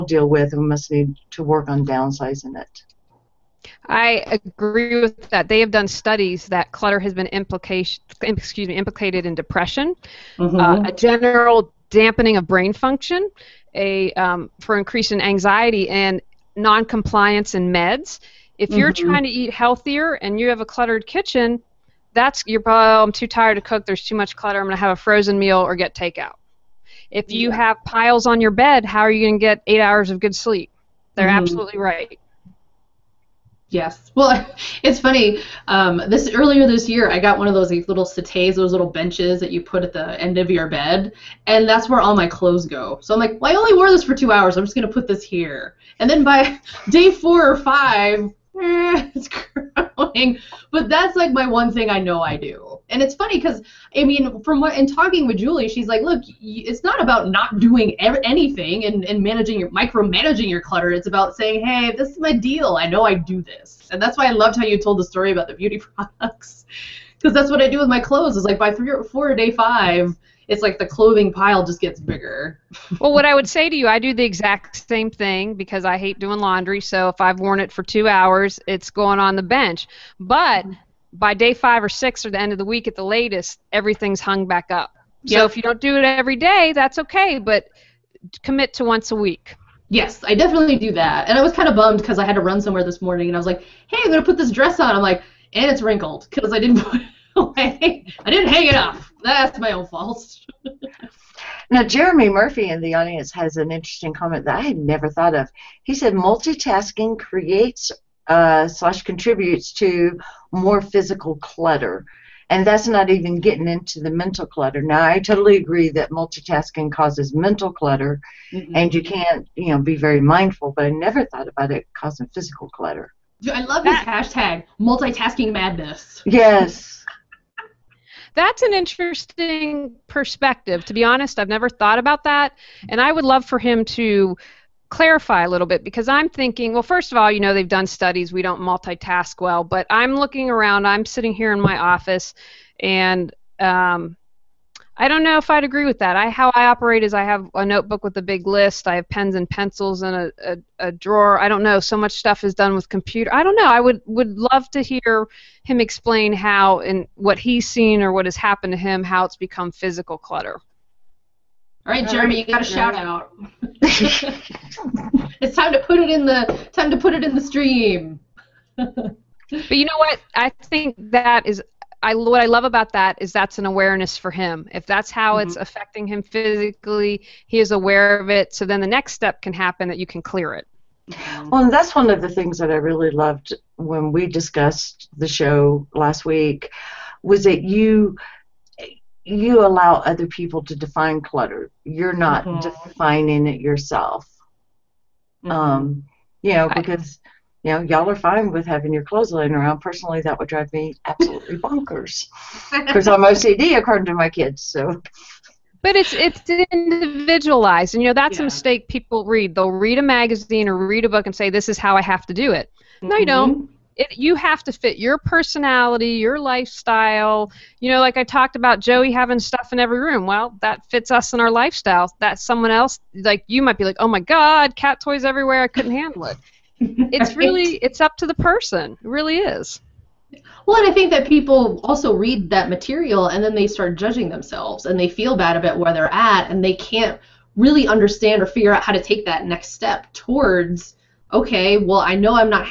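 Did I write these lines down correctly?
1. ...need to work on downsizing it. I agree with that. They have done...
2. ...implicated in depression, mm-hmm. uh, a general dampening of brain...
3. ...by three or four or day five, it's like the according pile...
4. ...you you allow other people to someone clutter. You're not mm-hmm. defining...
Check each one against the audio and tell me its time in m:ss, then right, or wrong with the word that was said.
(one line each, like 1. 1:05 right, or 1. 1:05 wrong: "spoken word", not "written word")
1. 0:00 right
2. 0:08 right
3. 1:08 wrong: "clothing", not "according"
4. 3:07 wrong: "define", not "someone".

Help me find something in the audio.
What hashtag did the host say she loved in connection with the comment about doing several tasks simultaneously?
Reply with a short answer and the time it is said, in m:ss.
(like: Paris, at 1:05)
multitasking madness, at 2:04.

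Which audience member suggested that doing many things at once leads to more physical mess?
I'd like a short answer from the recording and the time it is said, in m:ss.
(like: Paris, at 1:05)
Jeremy Murphy, at 1:41.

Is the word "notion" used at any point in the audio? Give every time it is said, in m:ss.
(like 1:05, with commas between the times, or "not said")
not said.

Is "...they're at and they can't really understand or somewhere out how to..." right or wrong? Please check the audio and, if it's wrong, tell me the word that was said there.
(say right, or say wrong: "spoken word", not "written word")
wrong: "figure", not "somewhere".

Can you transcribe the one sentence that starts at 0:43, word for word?
So I'm like, well, I only wore this for two hours.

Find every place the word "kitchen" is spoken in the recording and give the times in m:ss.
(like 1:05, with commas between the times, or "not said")
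0:21.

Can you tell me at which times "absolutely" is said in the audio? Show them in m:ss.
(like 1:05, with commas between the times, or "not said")
0:31, 3:21.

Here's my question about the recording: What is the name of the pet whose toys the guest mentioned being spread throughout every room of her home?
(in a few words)
Joey.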